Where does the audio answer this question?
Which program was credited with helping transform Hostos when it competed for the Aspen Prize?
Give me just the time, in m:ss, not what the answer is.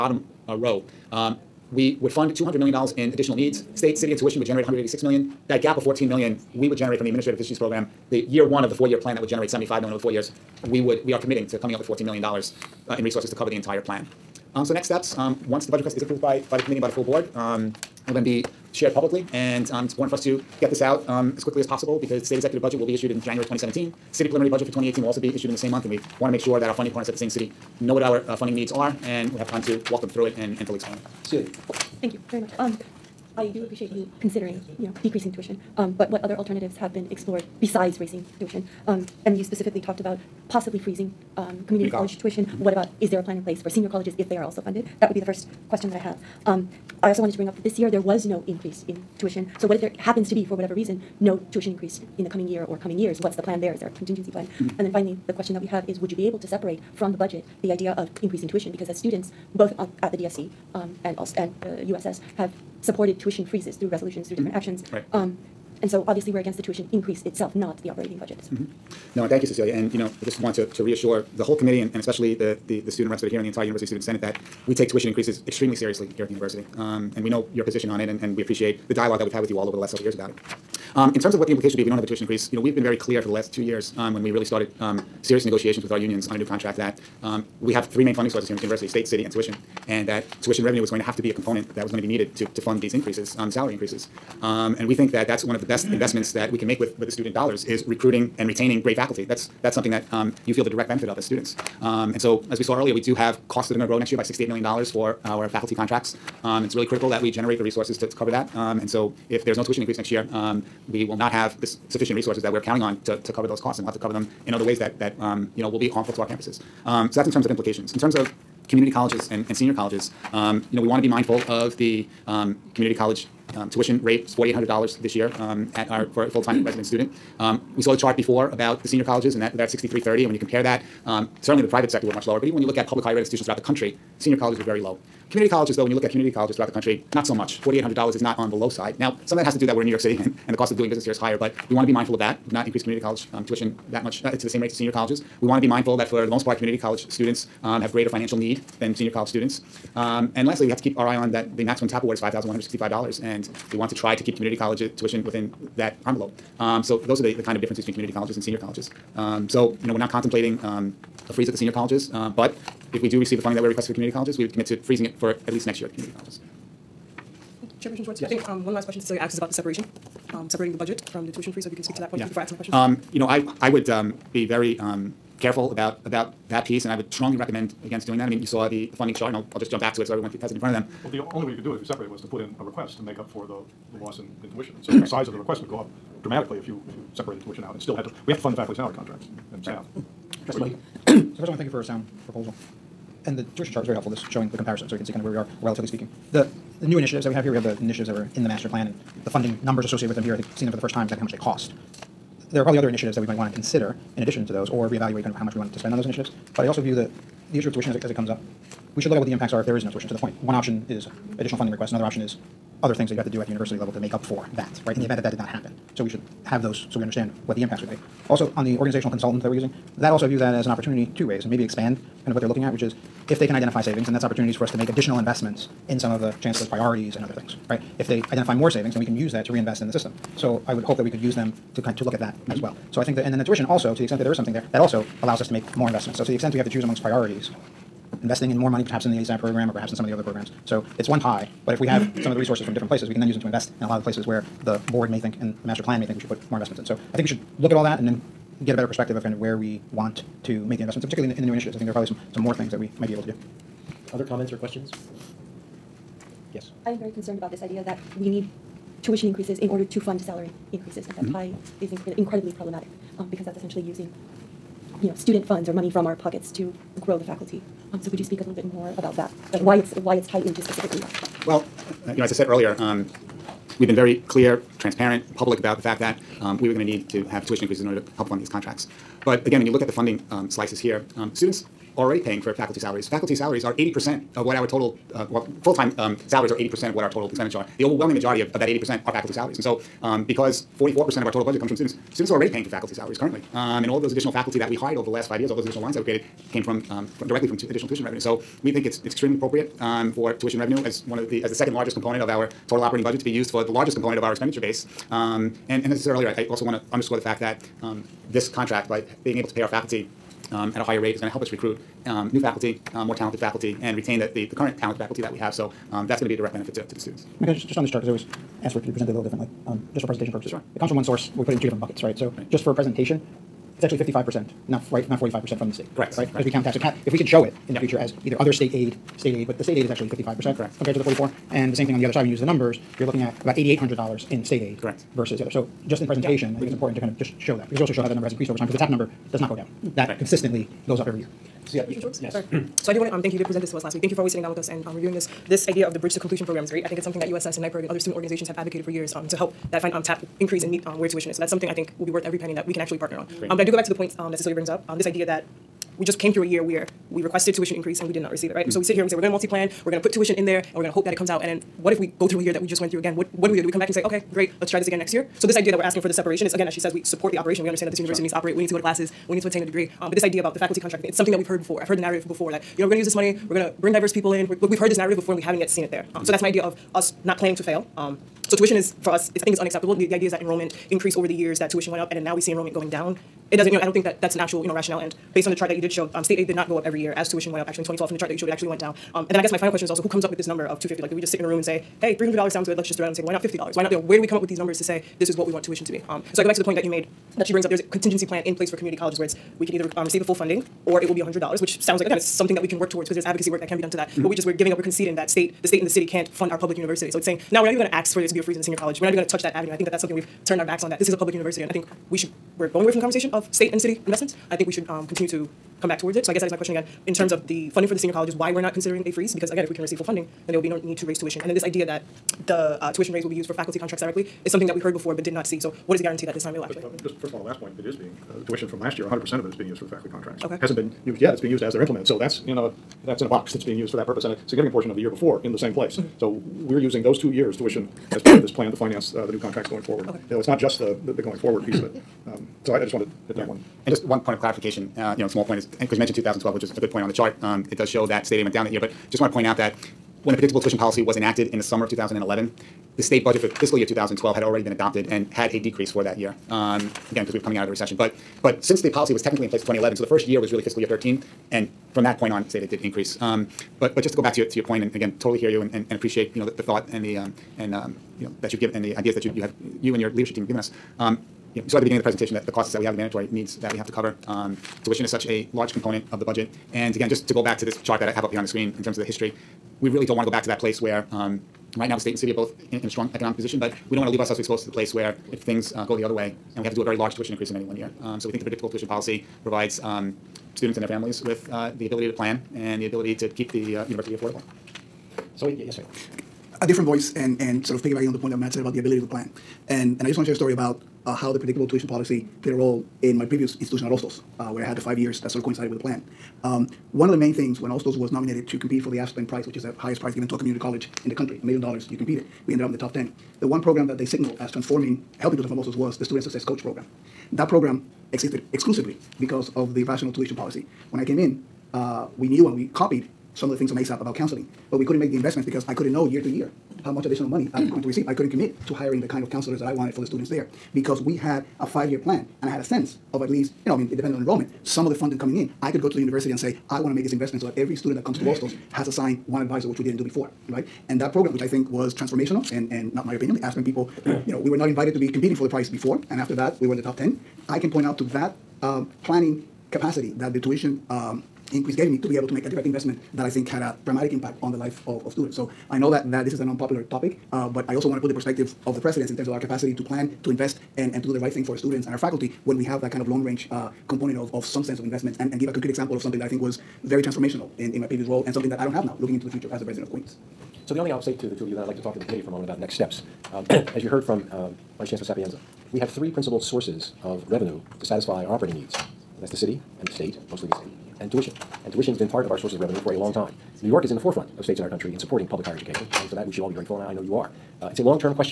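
8:36.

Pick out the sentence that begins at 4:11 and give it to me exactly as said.
I think there are probably some, some more things that we might be able to do.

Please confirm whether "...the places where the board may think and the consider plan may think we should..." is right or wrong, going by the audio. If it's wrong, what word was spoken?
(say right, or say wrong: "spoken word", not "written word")
wrong: "master", not "consider".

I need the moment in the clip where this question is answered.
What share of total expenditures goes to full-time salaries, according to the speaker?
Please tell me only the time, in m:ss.
4:43.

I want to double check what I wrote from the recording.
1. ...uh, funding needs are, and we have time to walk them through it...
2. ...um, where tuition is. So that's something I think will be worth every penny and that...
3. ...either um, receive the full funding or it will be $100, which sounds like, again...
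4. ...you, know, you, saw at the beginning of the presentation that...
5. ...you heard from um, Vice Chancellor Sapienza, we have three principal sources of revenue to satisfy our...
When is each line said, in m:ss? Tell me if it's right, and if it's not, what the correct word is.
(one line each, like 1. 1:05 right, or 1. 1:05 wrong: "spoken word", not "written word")
1. 0:28 right
2. 5:50 right
3. 6:39 right
4. 7:51 right
5. 9:33 right.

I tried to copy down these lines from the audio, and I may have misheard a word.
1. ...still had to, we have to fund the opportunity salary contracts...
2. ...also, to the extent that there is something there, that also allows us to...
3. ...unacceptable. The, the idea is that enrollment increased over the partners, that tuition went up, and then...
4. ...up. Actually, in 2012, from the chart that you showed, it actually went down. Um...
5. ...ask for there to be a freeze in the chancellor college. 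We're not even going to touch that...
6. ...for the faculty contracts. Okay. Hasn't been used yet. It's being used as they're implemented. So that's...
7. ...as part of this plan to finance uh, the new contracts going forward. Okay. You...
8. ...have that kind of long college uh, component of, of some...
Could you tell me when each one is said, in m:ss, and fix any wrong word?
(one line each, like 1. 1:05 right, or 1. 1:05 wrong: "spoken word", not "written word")
1. 3:07 wrong: "faculty", not "opportunity"
2. 3:53 right
3. 6:19 wrong: "years", not "partners"
4. 6:27 right
5. 6:47 wrong: "senior", not "chancellor"
6. 7:09 right
7. 7:18 right
8. 9:22 wrong: "range", not "college".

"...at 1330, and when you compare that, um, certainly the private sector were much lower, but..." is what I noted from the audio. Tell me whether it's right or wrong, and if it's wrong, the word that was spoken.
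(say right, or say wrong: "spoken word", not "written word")
wrong: "6330", not "1330".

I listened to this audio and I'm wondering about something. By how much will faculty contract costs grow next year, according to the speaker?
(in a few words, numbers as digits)
$68 million.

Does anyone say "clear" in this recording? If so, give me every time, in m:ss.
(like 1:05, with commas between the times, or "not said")
1:22, 4:34.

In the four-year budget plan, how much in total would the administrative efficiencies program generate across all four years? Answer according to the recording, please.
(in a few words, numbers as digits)
$75 million.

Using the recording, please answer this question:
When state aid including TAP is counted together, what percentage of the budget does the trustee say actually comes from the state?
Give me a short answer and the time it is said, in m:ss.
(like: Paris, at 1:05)
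55%, at 5:23.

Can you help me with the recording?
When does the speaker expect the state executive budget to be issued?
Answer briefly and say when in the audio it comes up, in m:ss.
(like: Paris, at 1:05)
January 2017, at 0:23.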